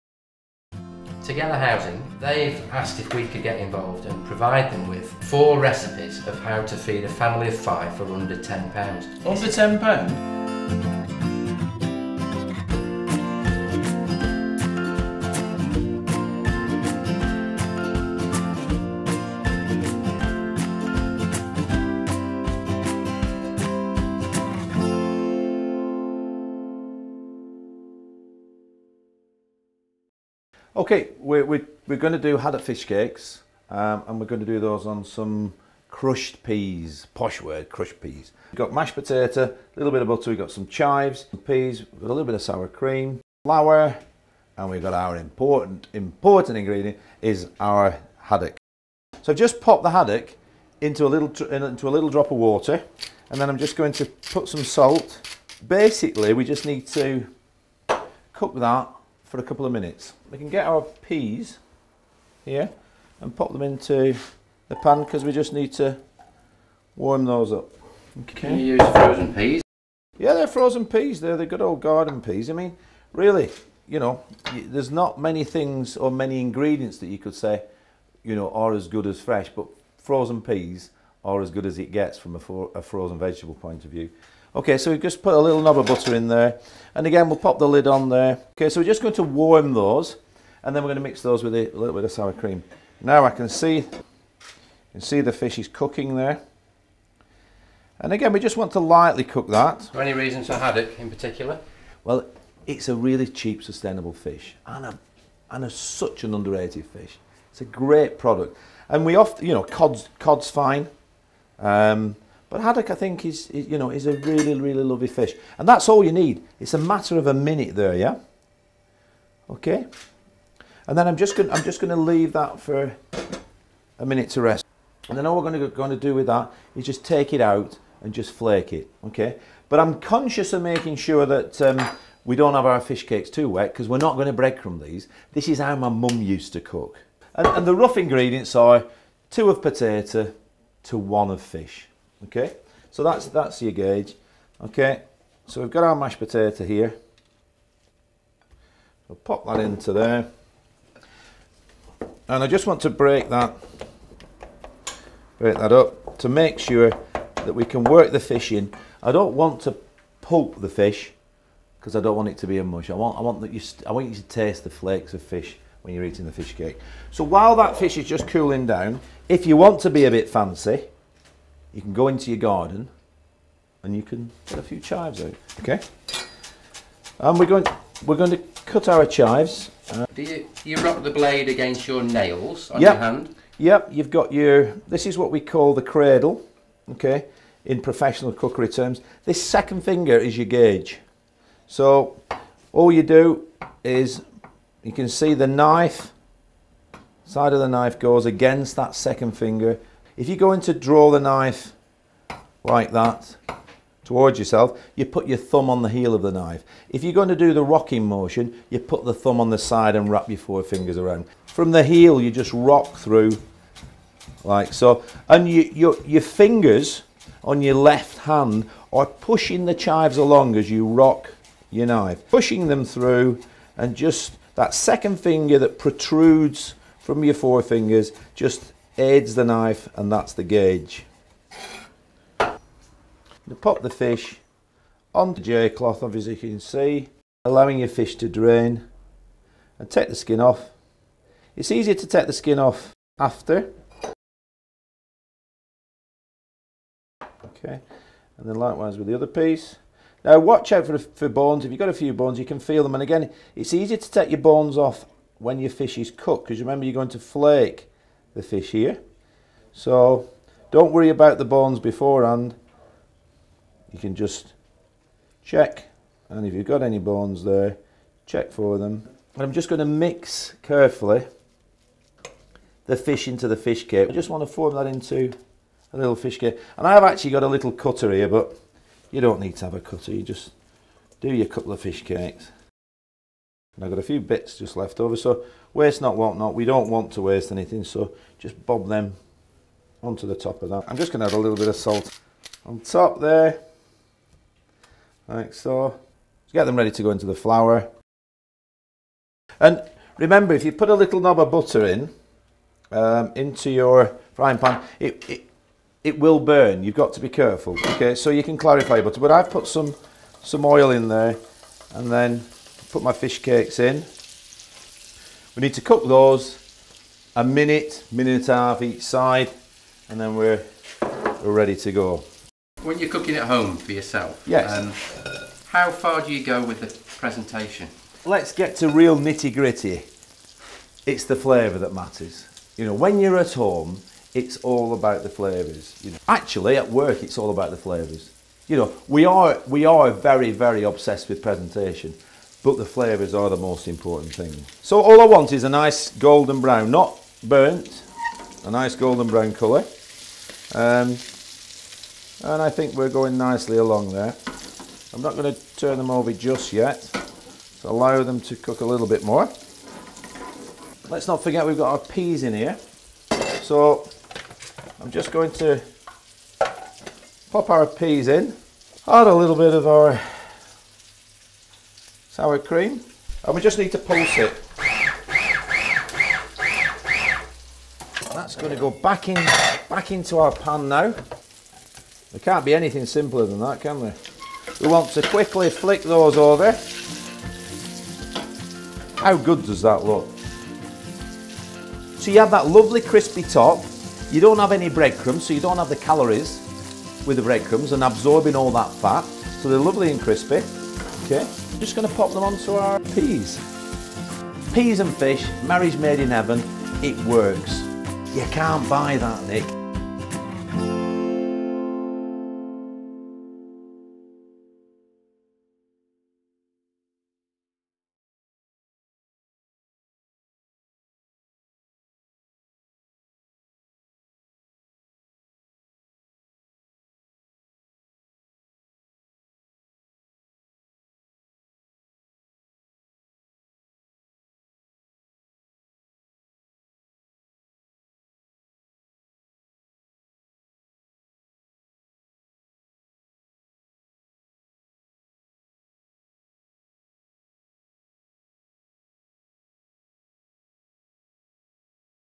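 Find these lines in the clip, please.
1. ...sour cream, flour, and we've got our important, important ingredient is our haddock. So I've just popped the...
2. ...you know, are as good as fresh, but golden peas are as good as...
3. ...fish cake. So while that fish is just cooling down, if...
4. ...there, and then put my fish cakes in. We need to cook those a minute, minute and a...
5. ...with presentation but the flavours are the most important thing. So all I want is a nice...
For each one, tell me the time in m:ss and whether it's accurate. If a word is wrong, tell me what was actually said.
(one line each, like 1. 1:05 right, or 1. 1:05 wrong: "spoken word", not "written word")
1. 0:42 right
2. 1:18 wrong: "frozen", not "golden"
3. 2:46 right
4. 5:11 right
5. 5:41 right.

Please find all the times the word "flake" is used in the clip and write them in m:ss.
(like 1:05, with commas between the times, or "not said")
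2:08, 2:44, 4:17.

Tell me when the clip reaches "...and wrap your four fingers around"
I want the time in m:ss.
3:29.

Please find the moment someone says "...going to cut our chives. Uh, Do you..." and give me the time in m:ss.
2:58.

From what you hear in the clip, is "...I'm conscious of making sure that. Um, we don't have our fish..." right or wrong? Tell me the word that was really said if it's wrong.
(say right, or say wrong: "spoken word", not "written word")
right.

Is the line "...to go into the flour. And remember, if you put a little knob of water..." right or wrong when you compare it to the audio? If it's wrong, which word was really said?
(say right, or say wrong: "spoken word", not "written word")
wrong: "butter", not "water".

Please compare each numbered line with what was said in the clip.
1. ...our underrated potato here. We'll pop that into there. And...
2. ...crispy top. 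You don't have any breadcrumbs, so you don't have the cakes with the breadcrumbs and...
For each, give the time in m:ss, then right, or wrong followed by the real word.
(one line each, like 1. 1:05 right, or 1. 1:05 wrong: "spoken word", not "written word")
1. 2:25 wrong: "mashed", not "underrated"
2. 6:33 wrong: "calories", not "cakes".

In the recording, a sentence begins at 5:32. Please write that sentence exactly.
You know, when you're at home, it's all about the flavours.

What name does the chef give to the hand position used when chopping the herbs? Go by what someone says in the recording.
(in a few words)
The cradle.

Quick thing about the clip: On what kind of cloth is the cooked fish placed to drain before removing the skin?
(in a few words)
J cloth.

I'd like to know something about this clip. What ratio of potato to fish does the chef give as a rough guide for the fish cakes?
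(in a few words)
2 to 1.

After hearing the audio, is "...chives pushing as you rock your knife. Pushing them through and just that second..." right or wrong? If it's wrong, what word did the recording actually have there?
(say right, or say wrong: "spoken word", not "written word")
wrong: "along", not "pushing".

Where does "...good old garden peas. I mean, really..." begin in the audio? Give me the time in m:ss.
1:11.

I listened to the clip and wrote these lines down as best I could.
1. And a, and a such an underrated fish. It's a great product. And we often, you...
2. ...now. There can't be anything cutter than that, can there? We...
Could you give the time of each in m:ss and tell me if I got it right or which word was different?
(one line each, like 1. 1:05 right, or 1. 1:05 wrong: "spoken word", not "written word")
1. 1:44 right
2. 6:20 wrong: "simpler", not "cutter".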